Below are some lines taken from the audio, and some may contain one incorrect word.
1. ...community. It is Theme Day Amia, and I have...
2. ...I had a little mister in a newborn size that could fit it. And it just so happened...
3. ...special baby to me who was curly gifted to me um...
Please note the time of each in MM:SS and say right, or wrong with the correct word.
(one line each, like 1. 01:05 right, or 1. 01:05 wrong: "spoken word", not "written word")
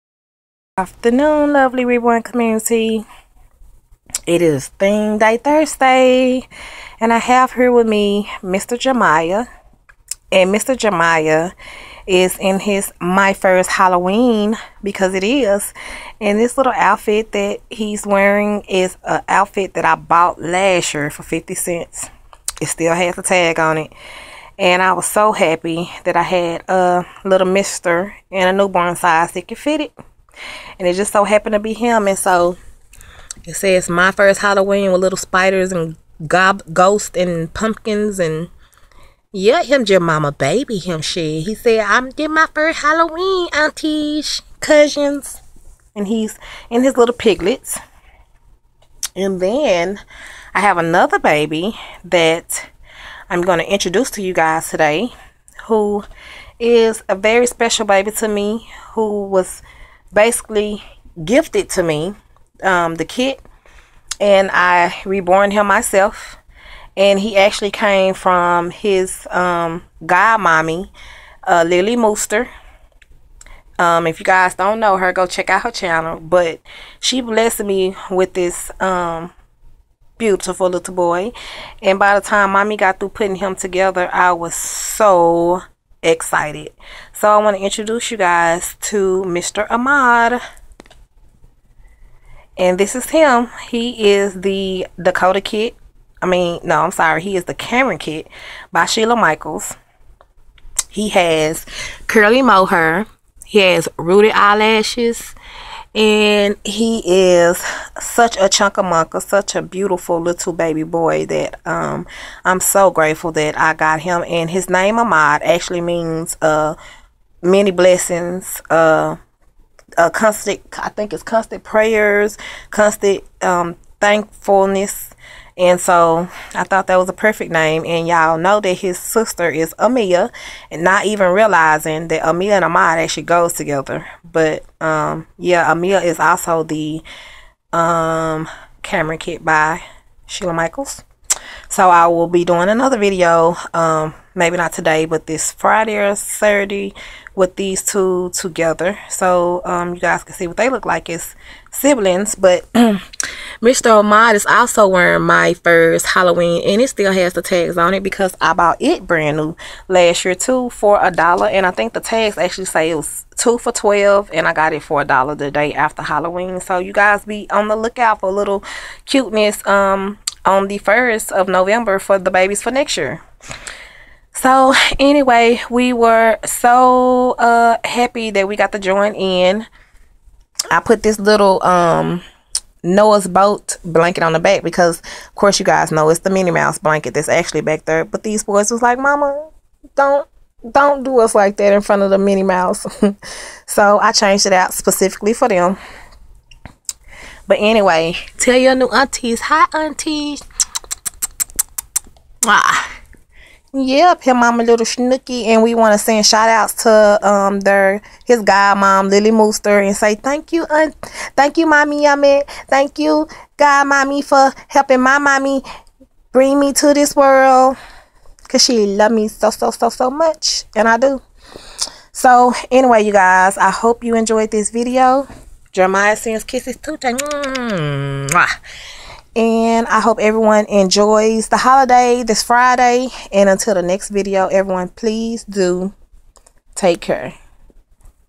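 1. 00:02 wrong: "Thursday", not "Amia"
2. 00:26 right
3. 00:57 wrong: "basically", not "curly".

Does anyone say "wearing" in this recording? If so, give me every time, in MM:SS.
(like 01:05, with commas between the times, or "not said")
00:18, 02:34.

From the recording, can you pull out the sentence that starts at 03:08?
But these boys was like, Mama, don't don't do us like that in front of the Minnie Mouse.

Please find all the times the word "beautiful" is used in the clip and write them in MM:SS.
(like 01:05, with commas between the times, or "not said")
01:20, 01:49.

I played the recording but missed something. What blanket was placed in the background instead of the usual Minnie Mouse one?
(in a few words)
Noah's boat blanket.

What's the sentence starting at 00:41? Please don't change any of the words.
He said, I'm getting my first Halloween, aunties, cousins.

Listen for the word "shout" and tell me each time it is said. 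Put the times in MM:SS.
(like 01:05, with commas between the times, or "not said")
03:26.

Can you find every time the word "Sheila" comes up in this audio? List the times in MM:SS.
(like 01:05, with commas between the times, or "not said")
01:38, 02:20.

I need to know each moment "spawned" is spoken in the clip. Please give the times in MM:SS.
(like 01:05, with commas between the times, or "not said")
not said.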